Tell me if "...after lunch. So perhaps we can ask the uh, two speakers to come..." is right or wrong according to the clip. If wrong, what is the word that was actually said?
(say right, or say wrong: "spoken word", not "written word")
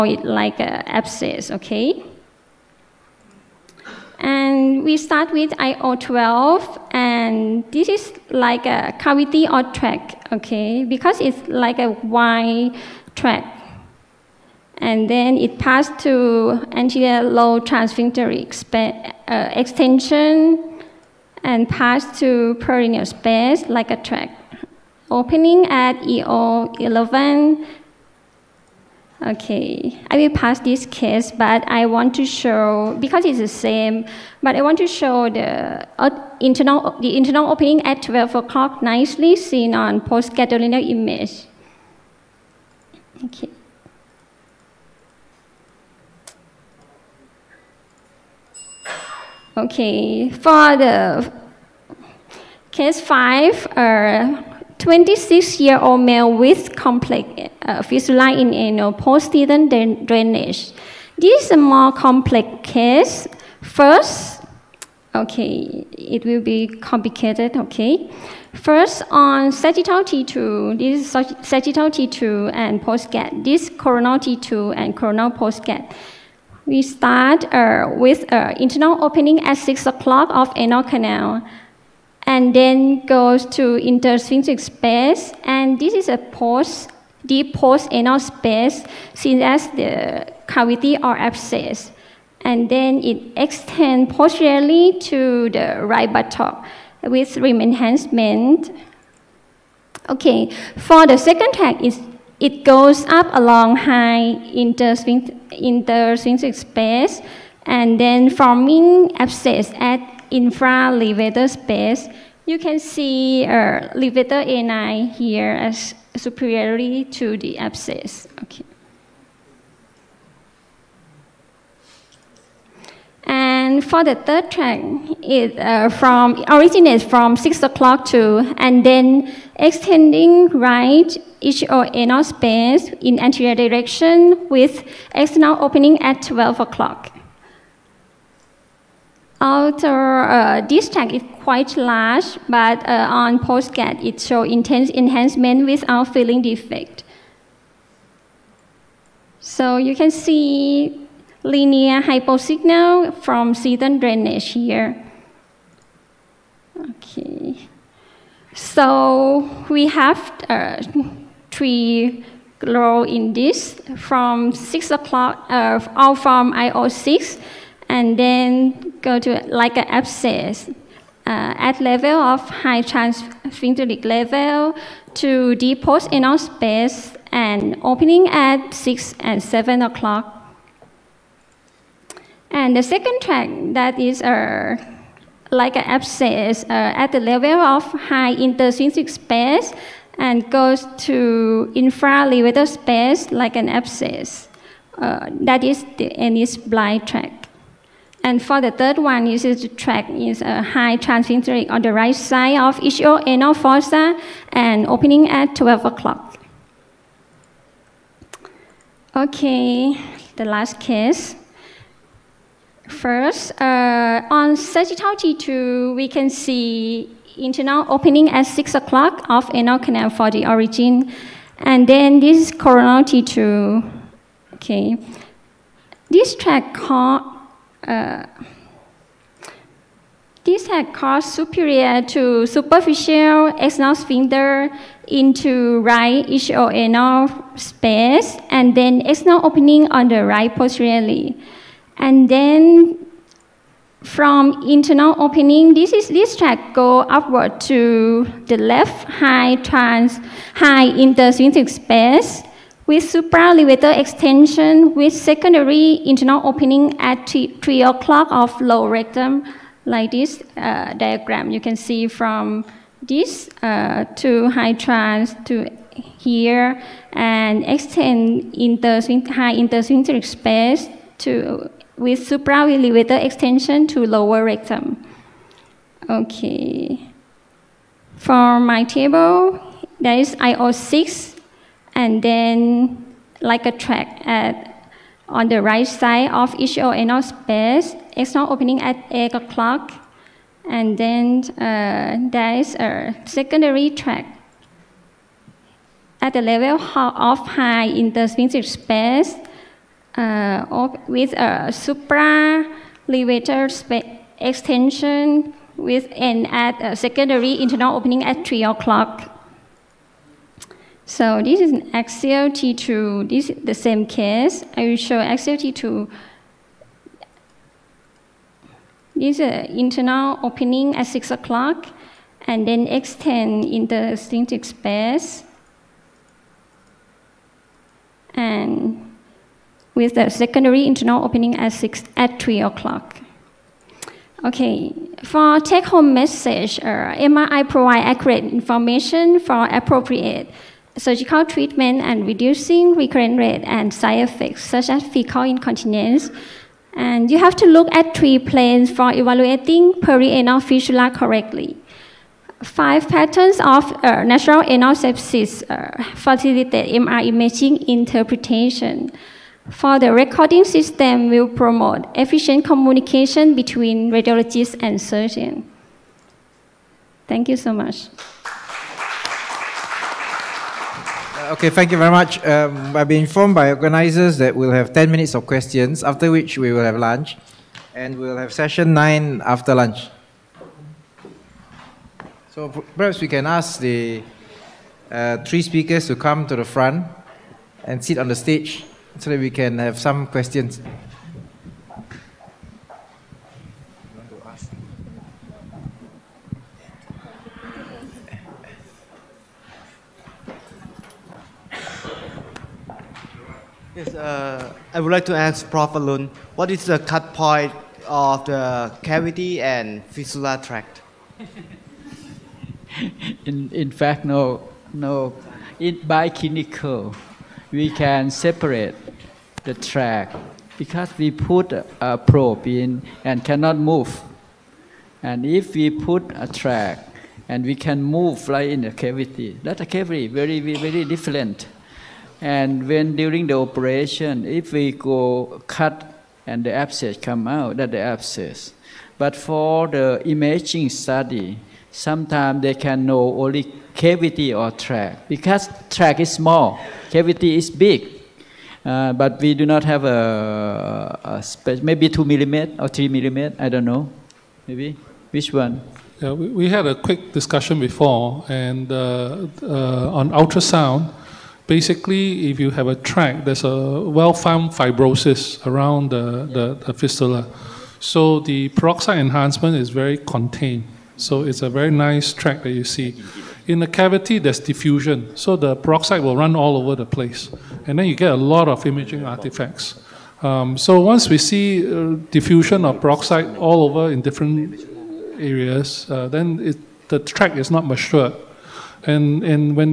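wrong: "three", not "two".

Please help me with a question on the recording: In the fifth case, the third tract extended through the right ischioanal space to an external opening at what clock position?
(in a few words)
12 o'clock.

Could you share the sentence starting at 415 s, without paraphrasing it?
In by clinical, we can separate the tract because we put a, probe in and cannot move.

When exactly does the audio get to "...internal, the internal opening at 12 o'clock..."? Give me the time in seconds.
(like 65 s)
36 s.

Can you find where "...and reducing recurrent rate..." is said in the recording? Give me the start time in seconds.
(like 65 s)
342 s.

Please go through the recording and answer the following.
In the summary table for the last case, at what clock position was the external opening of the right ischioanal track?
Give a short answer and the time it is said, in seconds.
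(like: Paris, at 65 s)
8 o'clock, at 288 s.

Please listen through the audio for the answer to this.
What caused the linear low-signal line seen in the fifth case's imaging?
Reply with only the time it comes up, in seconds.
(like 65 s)
153 s.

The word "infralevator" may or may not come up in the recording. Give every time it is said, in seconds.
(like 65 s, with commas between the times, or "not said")
110 s, 191 s.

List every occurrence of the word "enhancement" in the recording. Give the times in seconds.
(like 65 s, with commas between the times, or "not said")
97 s, 144 s, 469 s.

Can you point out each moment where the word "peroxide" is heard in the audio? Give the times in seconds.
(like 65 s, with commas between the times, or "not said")
468 s, 475 s, 483 s.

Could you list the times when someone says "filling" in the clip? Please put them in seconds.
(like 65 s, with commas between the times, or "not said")
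146 s.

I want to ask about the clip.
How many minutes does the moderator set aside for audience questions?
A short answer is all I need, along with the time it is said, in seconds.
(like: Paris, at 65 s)
10, at 374 s.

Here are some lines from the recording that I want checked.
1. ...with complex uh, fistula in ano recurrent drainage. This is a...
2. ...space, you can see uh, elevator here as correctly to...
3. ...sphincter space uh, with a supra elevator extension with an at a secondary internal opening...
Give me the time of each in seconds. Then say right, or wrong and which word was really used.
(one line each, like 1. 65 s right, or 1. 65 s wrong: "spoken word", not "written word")
1. 56 s wrong: "postdent", not "recurrent"
2. 111 s wrong: "superiorly", not "correctly"
3. 298 s right.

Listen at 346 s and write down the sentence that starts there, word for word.
And you have to look at three planes for evaluating perianal fistula correctly.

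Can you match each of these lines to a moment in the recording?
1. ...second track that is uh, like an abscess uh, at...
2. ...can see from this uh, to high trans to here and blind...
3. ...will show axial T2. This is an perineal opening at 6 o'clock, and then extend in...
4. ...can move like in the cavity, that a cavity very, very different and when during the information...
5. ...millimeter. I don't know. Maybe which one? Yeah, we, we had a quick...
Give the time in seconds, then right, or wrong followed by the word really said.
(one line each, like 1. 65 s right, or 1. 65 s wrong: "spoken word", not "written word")
1. 182 s right
2. 261 s wrong: "extend", not "blind"
3. 314 s wrong: "internal", not "perineal"
4. 427 s wrong: "operation", not "information"
5. 453 s right.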